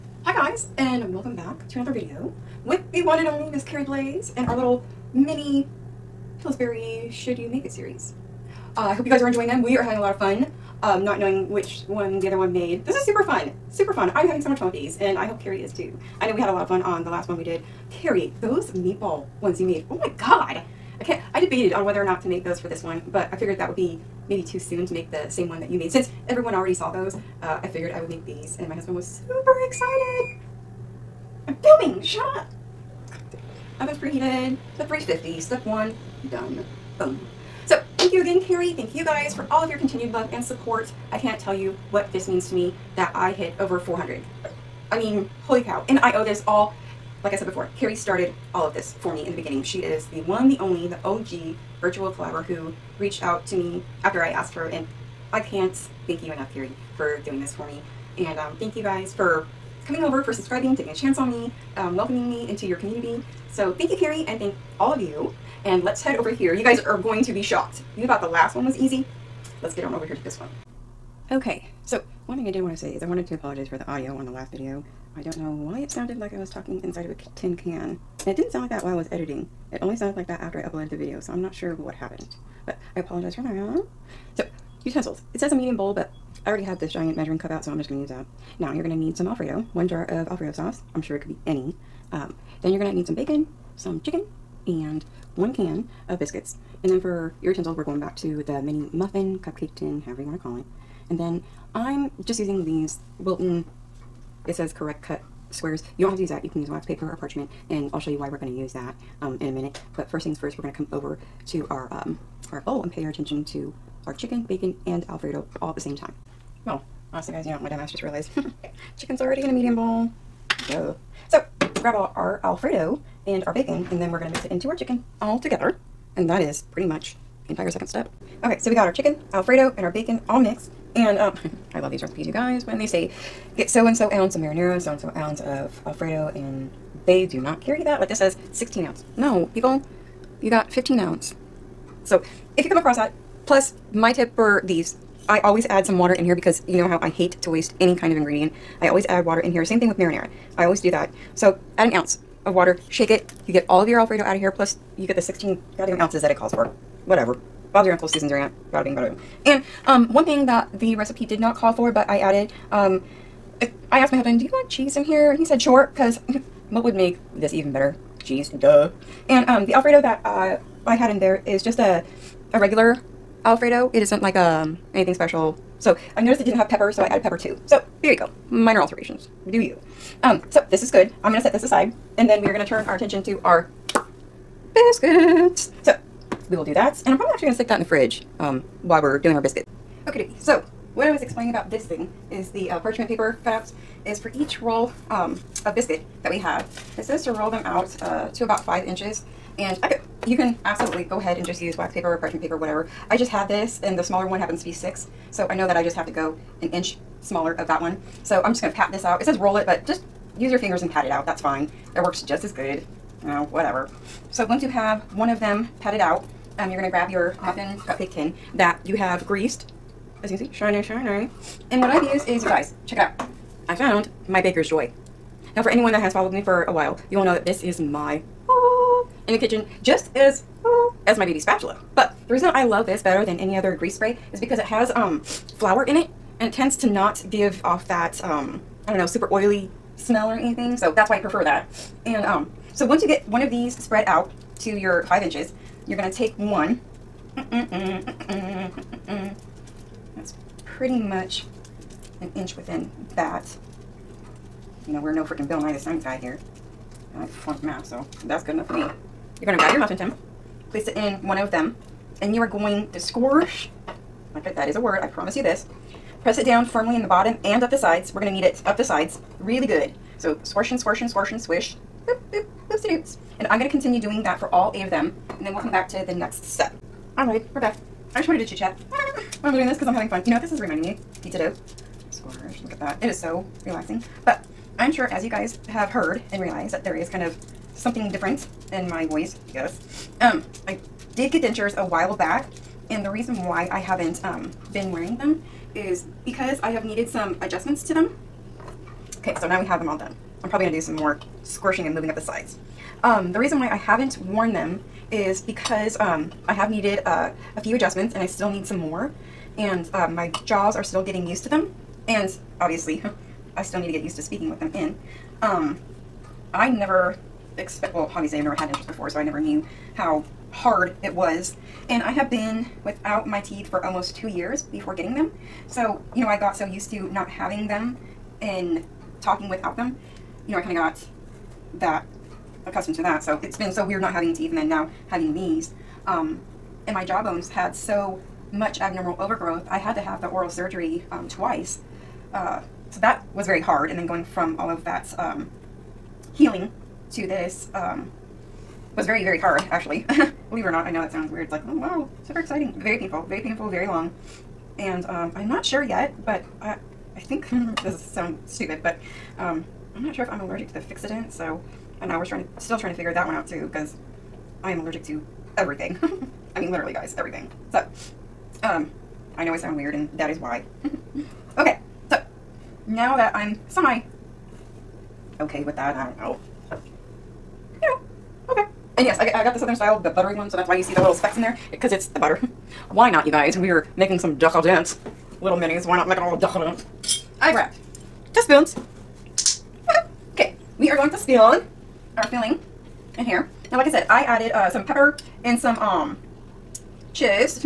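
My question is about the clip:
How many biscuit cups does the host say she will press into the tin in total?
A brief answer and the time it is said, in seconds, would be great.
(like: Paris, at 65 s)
8, at 274 s.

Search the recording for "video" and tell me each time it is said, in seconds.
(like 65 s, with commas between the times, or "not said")
1 s, 74 s, 80 s.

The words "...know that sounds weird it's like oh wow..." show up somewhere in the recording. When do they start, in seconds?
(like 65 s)
350 s.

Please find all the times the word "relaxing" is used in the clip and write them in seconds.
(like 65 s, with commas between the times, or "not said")
283 s.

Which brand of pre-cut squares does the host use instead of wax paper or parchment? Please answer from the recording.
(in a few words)
Wilton.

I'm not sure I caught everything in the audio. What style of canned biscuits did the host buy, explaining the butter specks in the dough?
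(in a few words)
Southern style.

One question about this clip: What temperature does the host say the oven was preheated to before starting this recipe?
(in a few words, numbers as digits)
350.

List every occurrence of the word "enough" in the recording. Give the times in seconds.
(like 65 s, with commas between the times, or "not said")
56 s, 258 s.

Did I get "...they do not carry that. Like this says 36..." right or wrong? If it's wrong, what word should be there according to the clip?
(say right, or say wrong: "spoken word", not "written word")
wrong: "16", not "36".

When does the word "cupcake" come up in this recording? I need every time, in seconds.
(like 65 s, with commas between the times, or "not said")
99 s, 217 s.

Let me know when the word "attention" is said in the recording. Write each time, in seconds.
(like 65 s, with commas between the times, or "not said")
113 s, 182 s.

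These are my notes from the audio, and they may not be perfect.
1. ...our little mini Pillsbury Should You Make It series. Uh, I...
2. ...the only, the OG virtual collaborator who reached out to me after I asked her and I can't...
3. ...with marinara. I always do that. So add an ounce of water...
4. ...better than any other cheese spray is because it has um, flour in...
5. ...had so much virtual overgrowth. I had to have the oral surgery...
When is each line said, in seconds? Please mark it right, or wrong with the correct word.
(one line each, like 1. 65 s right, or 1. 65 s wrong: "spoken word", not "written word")
1. 4 s right
2. 50 s right
3. 149 s right
4. 233 s wrong: "grease", not "cheese"
5. 337 s wrong: "abnormal", not "virtual".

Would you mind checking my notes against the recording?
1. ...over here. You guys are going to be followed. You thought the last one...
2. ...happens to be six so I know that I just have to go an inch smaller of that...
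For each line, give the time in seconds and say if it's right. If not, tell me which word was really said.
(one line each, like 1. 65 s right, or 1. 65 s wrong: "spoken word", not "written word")
1. 66 s wrong: "shocked", not "followed"
2. 204 s right.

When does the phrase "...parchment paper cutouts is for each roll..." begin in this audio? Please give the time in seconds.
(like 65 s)
192 s.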